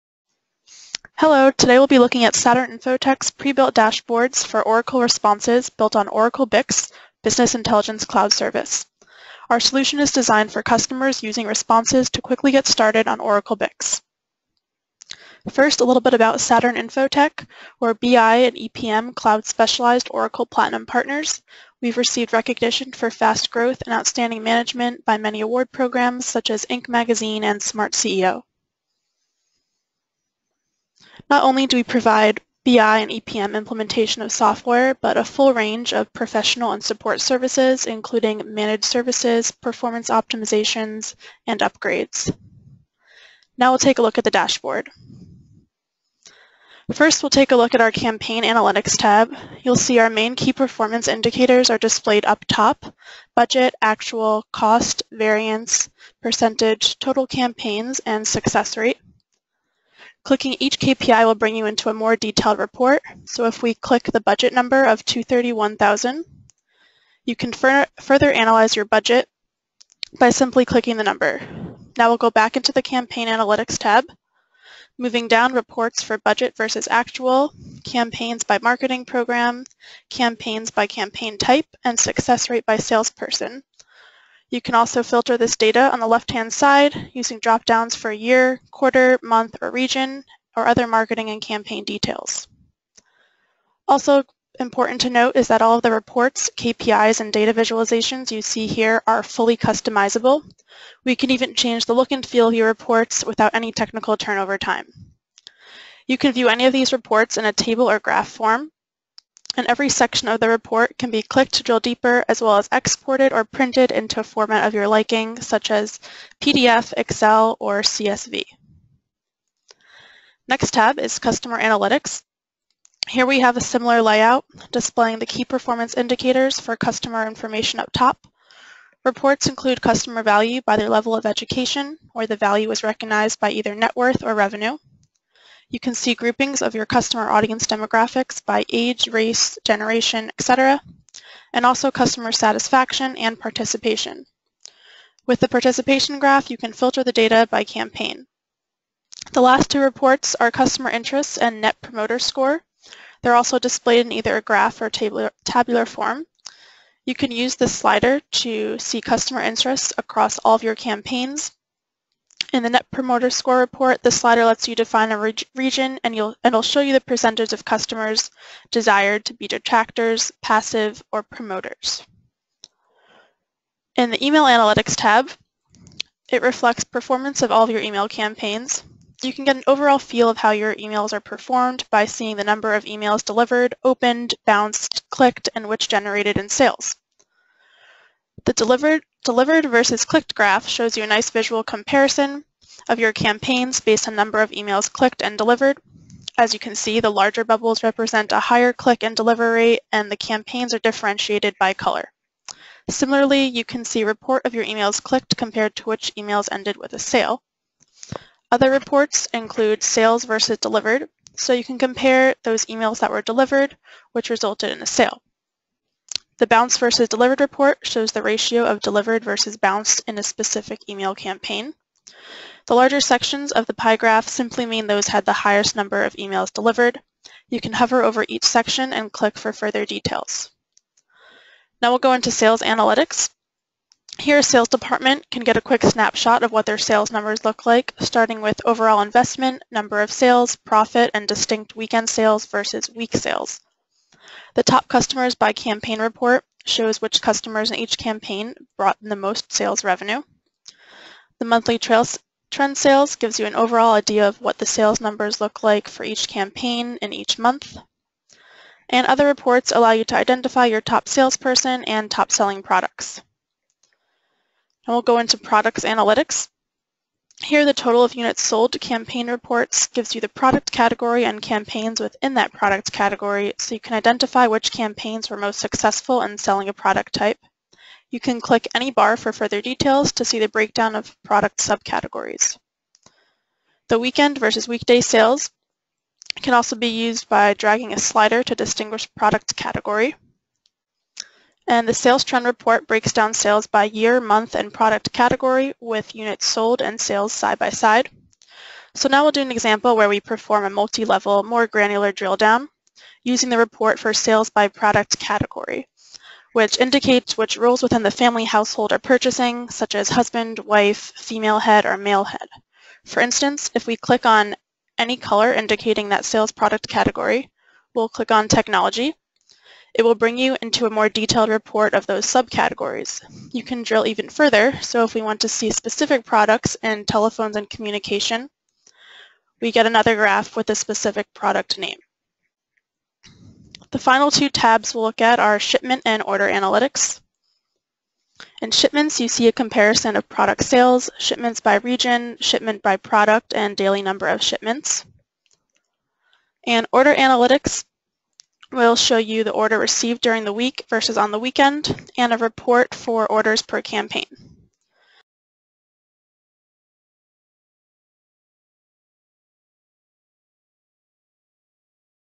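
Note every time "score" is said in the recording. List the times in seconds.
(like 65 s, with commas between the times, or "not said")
152 s, 163 s.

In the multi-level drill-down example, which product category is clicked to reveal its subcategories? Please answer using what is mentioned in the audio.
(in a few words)
Technology.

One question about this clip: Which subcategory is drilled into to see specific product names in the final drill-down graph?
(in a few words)
Telephones and communication.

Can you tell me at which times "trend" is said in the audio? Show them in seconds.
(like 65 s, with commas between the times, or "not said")
252 s, 292 s.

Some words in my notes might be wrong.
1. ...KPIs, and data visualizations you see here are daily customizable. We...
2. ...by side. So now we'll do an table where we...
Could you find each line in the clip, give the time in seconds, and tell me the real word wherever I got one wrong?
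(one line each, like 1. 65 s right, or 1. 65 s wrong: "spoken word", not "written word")
1. 96 s wrong: "fully", not "daily"
2. 297 s wrong: "example", not "table".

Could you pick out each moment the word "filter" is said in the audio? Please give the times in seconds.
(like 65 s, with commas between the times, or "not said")
85 s, 146 s.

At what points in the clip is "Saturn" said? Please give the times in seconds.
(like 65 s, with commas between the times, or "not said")
2 s, 16 s.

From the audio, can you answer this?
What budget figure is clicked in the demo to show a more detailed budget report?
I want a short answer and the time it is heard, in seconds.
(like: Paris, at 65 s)
231,000, at 65 s.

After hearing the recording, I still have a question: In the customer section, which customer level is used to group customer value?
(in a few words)
Education.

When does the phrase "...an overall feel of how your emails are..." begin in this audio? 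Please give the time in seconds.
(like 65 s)
179 s.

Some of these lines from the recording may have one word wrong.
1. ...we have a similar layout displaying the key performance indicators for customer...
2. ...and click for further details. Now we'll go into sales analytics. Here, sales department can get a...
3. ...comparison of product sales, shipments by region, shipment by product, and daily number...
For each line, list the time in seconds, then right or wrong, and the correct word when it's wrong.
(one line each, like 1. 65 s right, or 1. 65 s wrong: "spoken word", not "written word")
1. 123 s right
2. 228 s right
3. 339 s right.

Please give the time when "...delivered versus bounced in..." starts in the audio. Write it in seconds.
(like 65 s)
218 s.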